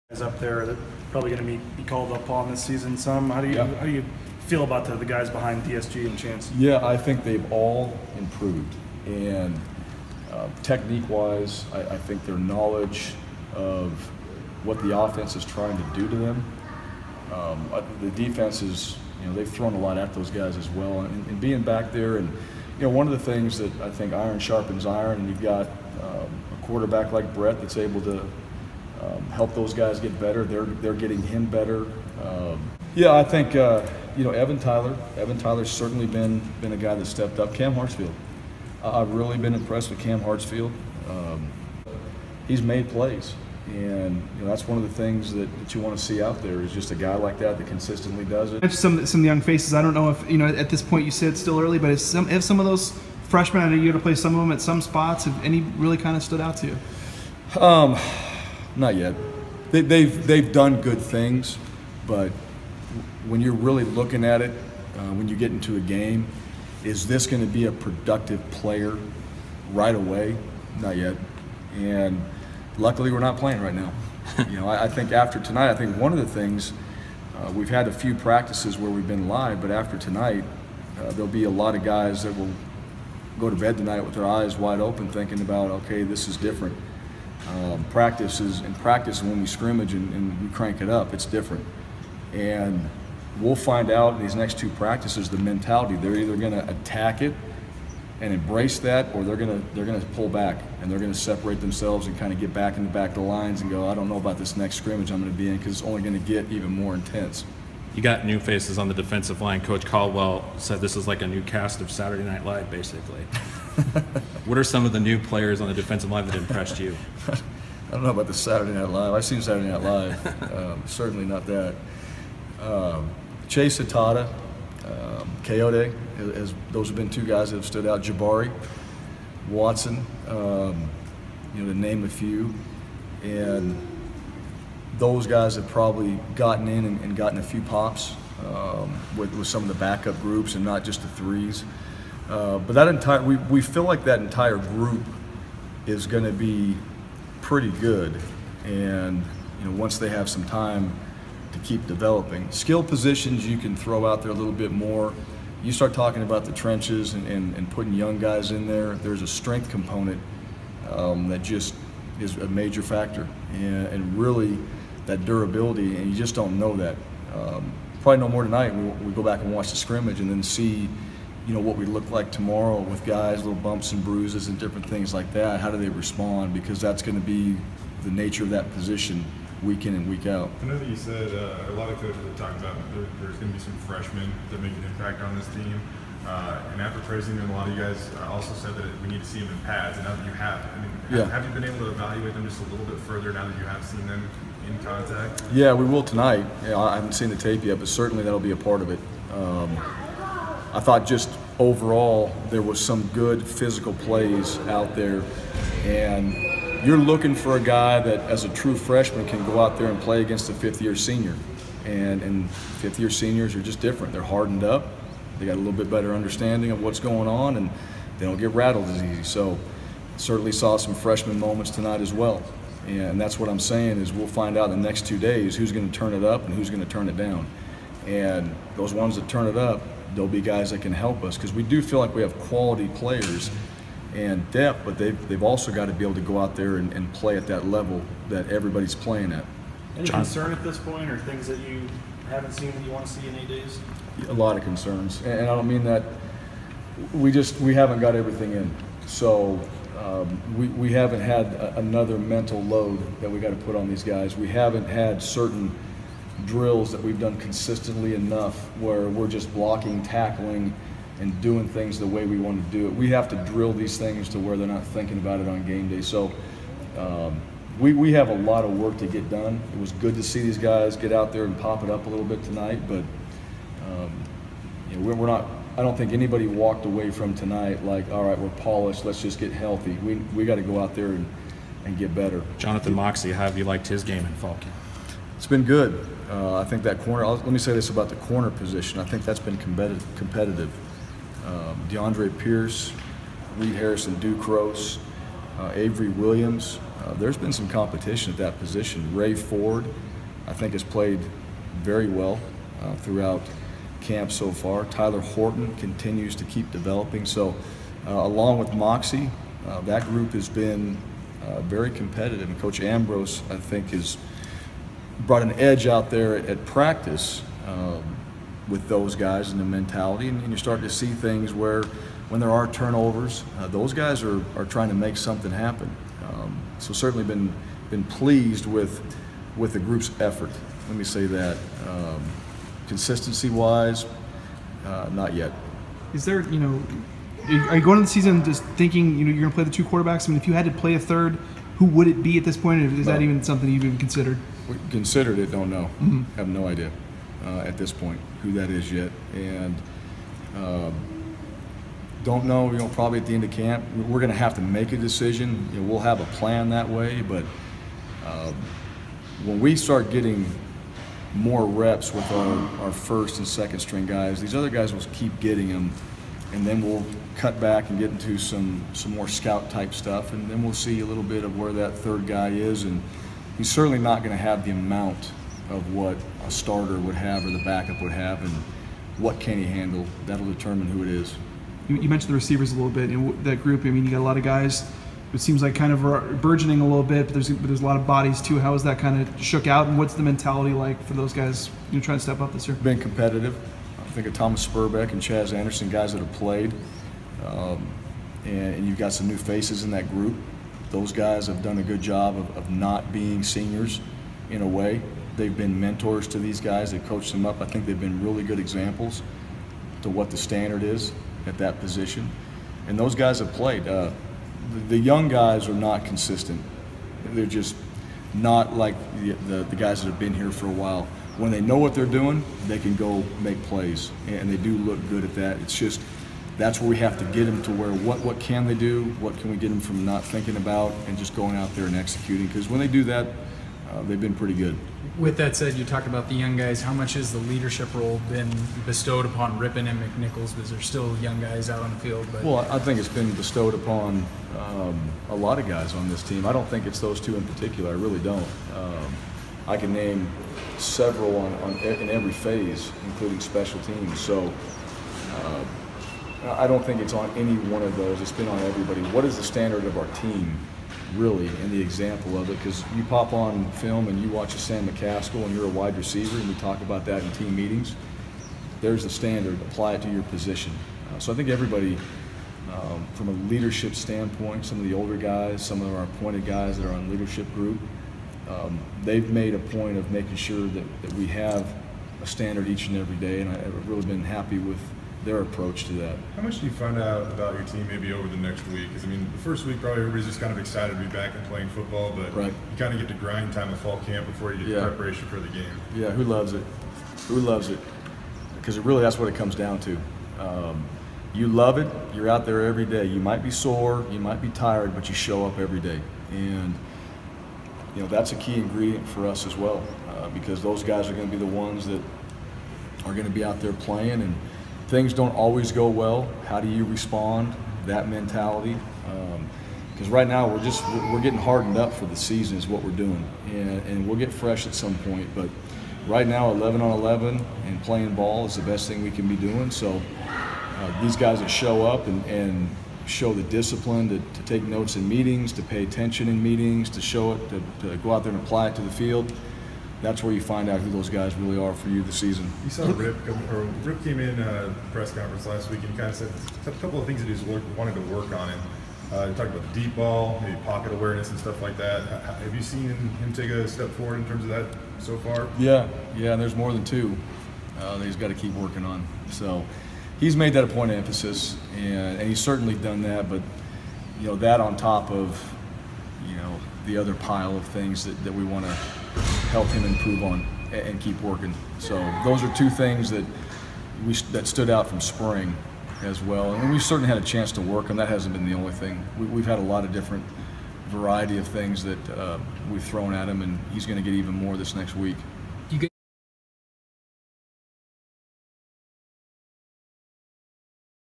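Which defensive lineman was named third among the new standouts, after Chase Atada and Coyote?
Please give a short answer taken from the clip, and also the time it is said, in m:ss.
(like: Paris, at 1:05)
Jabari Watson, at 2:08.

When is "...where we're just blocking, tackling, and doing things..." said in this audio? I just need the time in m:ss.
4:18.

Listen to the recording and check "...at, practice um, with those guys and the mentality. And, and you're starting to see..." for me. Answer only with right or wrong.
right.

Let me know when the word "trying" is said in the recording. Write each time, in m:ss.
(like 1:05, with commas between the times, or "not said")
0:15, 5:24, 6:32.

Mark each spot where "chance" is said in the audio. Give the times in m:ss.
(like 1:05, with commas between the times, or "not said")
0:06, 9:37.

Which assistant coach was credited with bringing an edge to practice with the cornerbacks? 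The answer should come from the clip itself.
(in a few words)
Coach Ambrose.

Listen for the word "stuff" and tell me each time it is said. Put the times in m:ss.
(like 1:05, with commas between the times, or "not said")
6:09, 9:11.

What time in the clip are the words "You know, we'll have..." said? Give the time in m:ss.
5:55.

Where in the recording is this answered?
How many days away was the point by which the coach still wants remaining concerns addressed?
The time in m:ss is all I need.
4:03.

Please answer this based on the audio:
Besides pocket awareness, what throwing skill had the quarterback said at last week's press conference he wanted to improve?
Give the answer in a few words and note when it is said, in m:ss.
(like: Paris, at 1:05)
The deep ball, at 9:09.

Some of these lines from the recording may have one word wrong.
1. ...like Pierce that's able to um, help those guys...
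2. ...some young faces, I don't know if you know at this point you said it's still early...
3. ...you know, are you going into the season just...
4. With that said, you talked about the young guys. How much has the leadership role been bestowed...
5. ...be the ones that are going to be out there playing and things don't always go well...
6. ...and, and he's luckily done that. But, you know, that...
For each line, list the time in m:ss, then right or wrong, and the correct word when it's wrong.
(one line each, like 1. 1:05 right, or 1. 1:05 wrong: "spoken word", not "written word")
1. 0:27 wrong: "Brett", not "Pierce"
2. 0:49 right
3. 5:36 right
4. 7:15 right
5. 8:31 right
6. 9:21 wrong: "certainly", not "luckily".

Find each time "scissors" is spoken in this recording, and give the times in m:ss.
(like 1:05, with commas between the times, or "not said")
not said.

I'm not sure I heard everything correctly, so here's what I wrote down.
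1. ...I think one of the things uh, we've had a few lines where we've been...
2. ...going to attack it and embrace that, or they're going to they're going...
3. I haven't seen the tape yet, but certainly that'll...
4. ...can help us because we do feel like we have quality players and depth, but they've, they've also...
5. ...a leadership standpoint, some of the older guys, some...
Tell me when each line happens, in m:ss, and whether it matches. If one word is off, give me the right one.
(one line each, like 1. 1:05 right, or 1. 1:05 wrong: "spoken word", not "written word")
1. 1:15 wrong: "practices", not "lines"
2. 1:36 right
3. 3:16 right
4. 3:50 right
5. 7:53 right.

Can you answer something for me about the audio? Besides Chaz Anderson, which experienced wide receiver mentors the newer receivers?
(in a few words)
Thomas Sperbeck.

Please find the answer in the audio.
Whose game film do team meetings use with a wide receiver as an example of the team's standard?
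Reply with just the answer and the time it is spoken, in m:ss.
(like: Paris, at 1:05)
Sam McCaskill, at 7:44.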